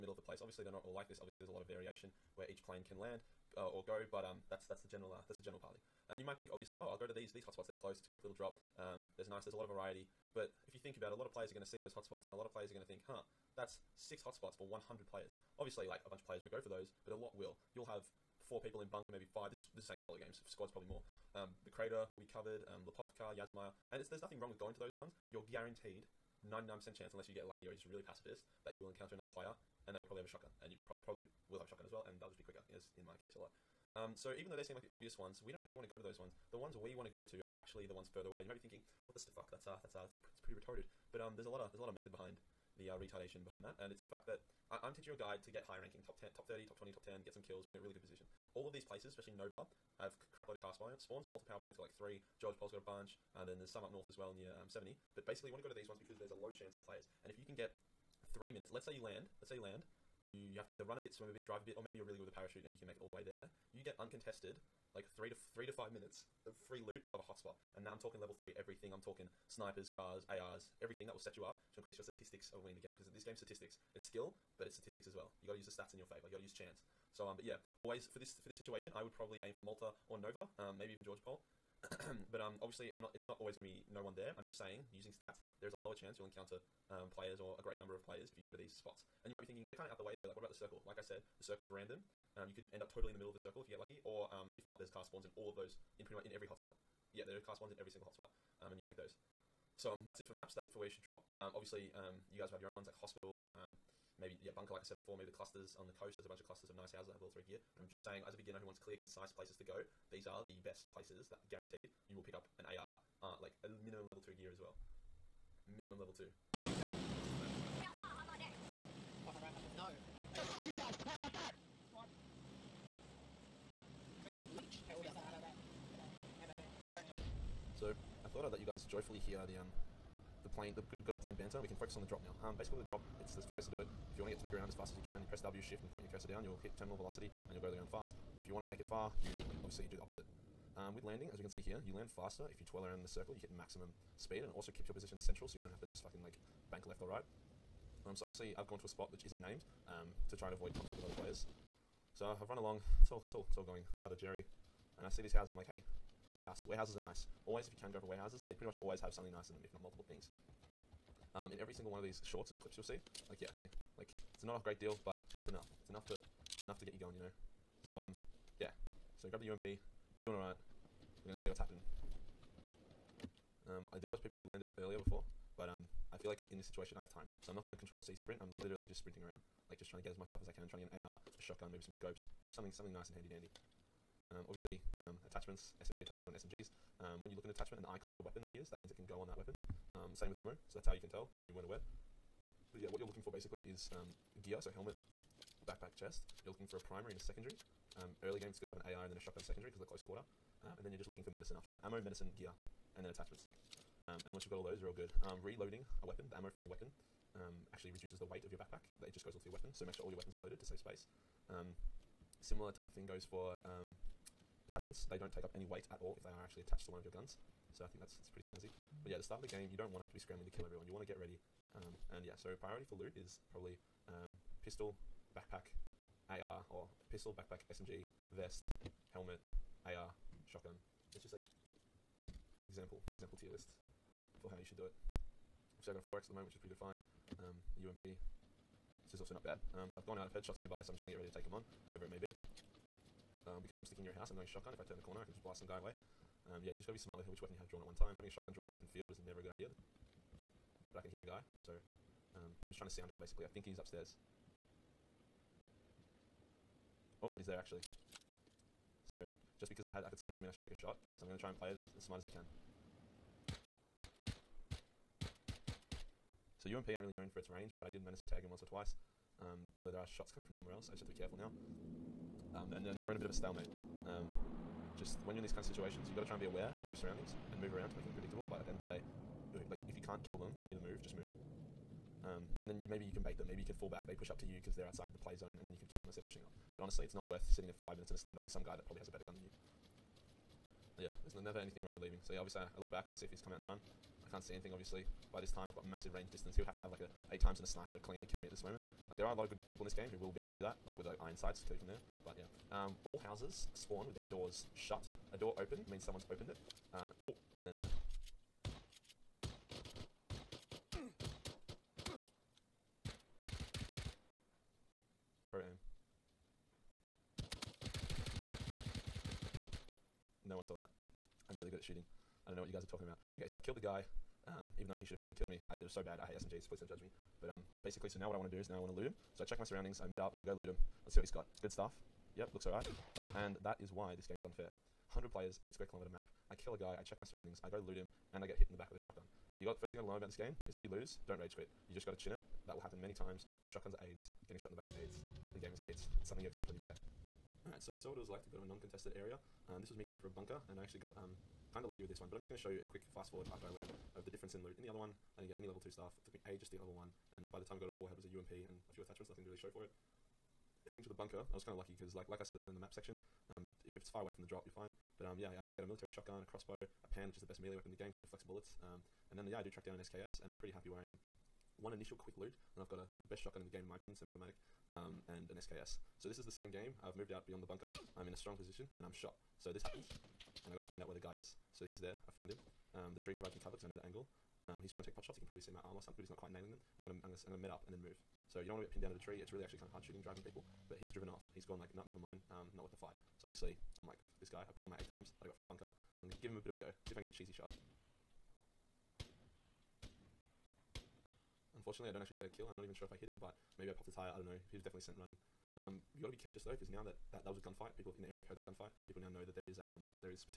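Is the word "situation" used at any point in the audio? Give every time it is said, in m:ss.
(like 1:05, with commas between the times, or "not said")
1:18, 2:56, 4:35.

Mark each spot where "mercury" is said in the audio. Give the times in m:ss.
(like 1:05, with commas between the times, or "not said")
not said.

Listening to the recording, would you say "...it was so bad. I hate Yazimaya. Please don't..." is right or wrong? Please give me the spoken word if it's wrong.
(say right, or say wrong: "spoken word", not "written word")
wrong: "SMGs", not "Yazimaya".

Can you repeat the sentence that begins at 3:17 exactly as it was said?
Um, early game, it's good to have an AR and then a shotgun secondary because of the close quarter.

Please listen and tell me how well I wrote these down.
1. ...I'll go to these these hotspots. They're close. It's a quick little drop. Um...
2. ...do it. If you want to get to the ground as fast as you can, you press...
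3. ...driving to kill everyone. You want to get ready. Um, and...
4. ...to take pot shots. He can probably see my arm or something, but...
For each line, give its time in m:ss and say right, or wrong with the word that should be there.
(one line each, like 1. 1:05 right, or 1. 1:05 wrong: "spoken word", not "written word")
1. 0:06 right
2. 2:13 right
3. 3:40 wrong: "scrambling", not "driving"
4. 6:25 right.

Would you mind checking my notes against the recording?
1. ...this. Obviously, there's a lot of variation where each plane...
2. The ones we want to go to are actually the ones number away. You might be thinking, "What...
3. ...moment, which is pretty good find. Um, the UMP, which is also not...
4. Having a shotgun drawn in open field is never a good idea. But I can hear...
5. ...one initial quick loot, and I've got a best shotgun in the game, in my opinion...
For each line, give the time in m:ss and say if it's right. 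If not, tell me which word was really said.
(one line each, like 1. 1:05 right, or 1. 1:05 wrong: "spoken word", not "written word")
1. 0:01 right
2. 0:36 wrong: "further", not "number"
3. 3:56 right
4. 4:08 right
5. 6:11 right.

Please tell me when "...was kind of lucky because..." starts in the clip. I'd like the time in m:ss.
6:01.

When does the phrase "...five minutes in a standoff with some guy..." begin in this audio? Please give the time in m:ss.
4:47.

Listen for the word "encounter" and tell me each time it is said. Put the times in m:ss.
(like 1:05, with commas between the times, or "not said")
0:28, 1:26.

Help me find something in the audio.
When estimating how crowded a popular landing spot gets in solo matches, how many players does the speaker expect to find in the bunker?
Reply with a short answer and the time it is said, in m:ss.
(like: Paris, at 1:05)
4, at 0:18.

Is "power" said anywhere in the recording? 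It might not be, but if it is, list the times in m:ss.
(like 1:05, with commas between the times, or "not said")
0:51.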